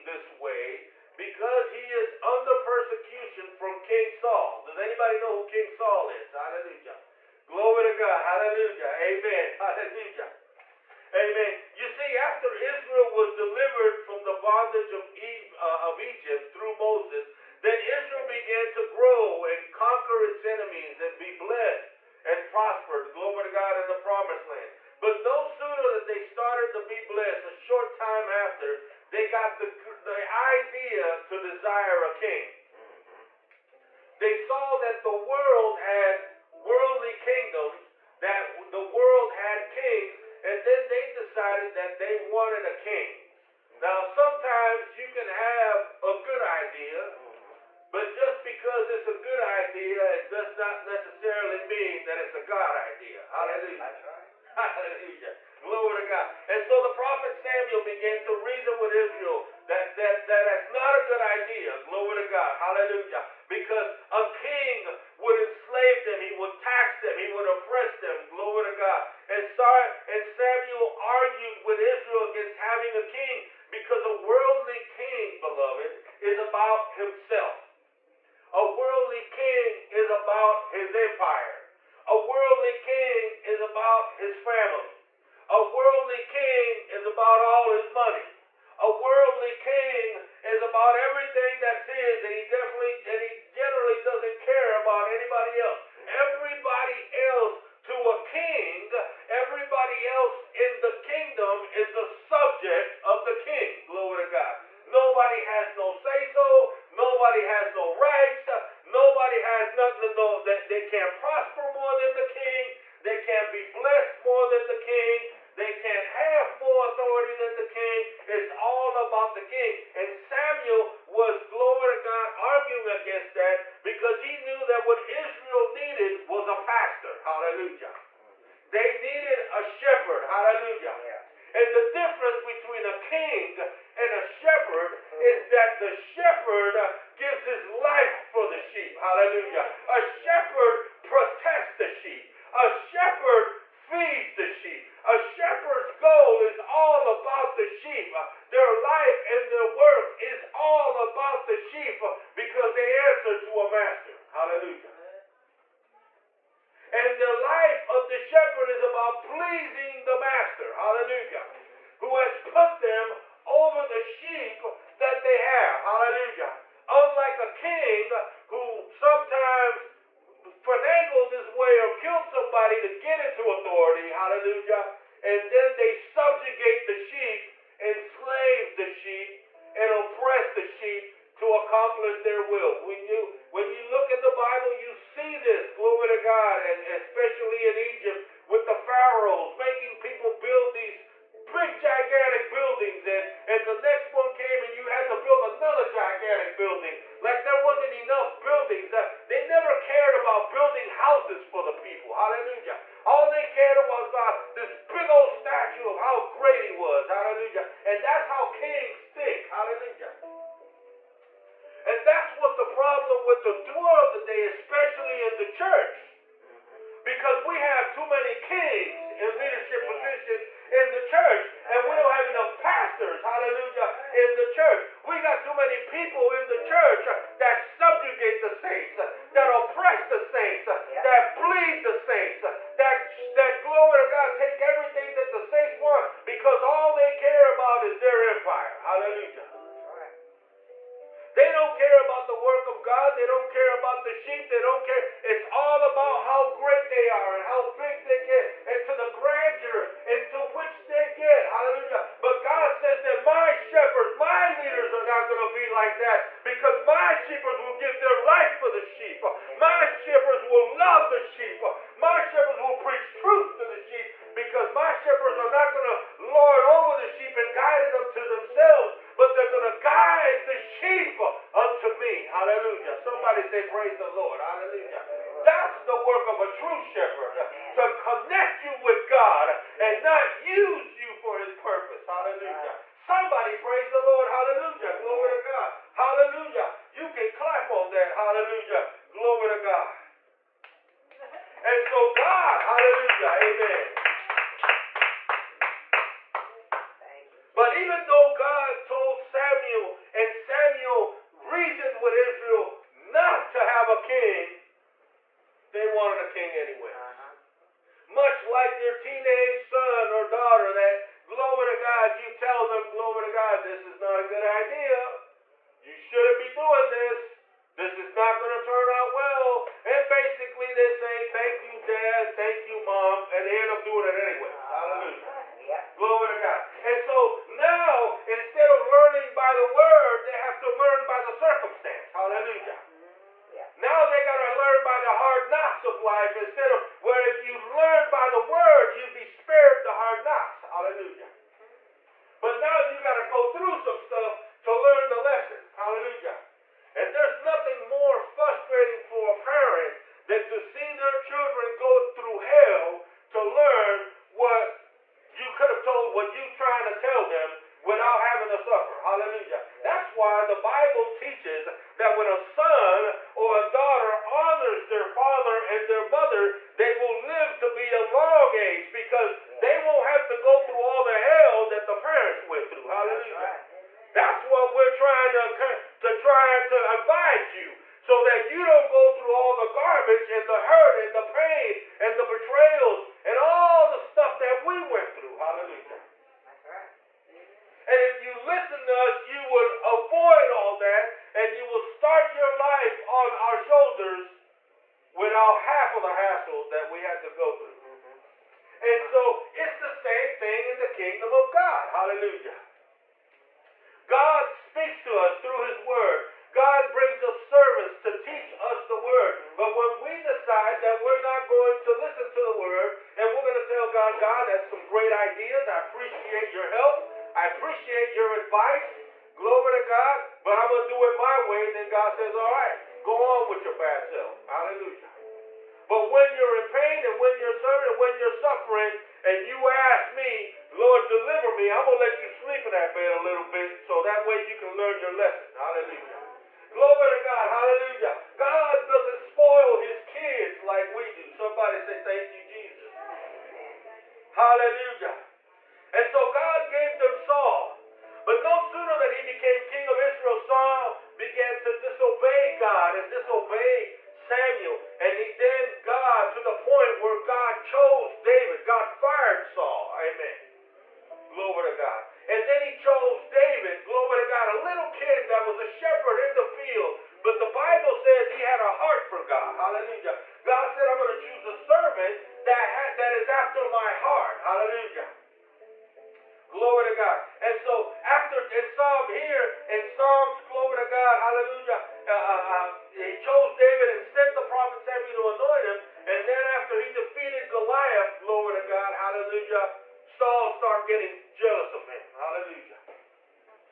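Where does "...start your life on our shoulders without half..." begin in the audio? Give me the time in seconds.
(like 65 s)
391 s.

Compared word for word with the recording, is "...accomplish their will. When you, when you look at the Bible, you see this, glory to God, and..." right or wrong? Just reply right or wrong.
right.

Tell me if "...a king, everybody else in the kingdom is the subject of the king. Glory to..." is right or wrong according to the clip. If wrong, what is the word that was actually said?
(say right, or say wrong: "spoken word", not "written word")
right.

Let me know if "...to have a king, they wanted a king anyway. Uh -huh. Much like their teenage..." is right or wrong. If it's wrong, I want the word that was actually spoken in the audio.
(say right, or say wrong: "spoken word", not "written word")
right.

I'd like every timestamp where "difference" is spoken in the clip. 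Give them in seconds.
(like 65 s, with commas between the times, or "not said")
131 s.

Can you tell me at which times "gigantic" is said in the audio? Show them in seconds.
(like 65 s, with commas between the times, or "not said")
191 s, 195 s.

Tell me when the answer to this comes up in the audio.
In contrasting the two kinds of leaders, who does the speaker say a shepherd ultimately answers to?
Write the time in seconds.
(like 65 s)
152 s.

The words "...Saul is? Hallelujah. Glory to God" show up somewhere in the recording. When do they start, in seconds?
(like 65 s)
5 s.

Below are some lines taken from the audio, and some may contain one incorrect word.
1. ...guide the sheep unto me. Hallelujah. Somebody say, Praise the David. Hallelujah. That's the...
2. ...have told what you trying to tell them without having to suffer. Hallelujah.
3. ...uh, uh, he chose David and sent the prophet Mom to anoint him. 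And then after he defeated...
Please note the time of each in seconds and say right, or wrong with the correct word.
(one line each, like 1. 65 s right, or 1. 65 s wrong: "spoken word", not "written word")
1. 269 s wrong: "Lord", not "David"
2. 355 s right
3. 482 s wrong: "Samuel", not "Mom".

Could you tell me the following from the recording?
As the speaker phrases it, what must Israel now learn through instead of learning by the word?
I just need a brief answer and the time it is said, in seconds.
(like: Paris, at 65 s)
The hard knocks of life, at 335 s.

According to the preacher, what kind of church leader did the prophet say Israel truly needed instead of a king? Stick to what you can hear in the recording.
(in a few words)
A pastor.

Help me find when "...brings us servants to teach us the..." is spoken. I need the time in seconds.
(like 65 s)
406 s.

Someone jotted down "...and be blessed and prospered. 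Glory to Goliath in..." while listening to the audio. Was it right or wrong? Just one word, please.
wrong.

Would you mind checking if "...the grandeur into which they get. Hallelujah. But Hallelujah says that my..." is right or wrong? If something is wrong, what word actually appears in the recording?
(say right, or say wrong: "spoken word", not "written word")
wrong: "God", not "Hallelujah".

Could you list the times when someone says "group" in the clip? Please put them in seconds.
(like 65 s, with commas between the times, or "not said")
not said.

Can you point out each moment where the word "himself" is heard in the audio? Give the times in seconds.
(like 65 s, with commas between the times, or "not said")
76 s.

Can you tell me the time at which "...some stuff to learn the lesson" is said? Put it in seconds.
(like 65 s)
343 s.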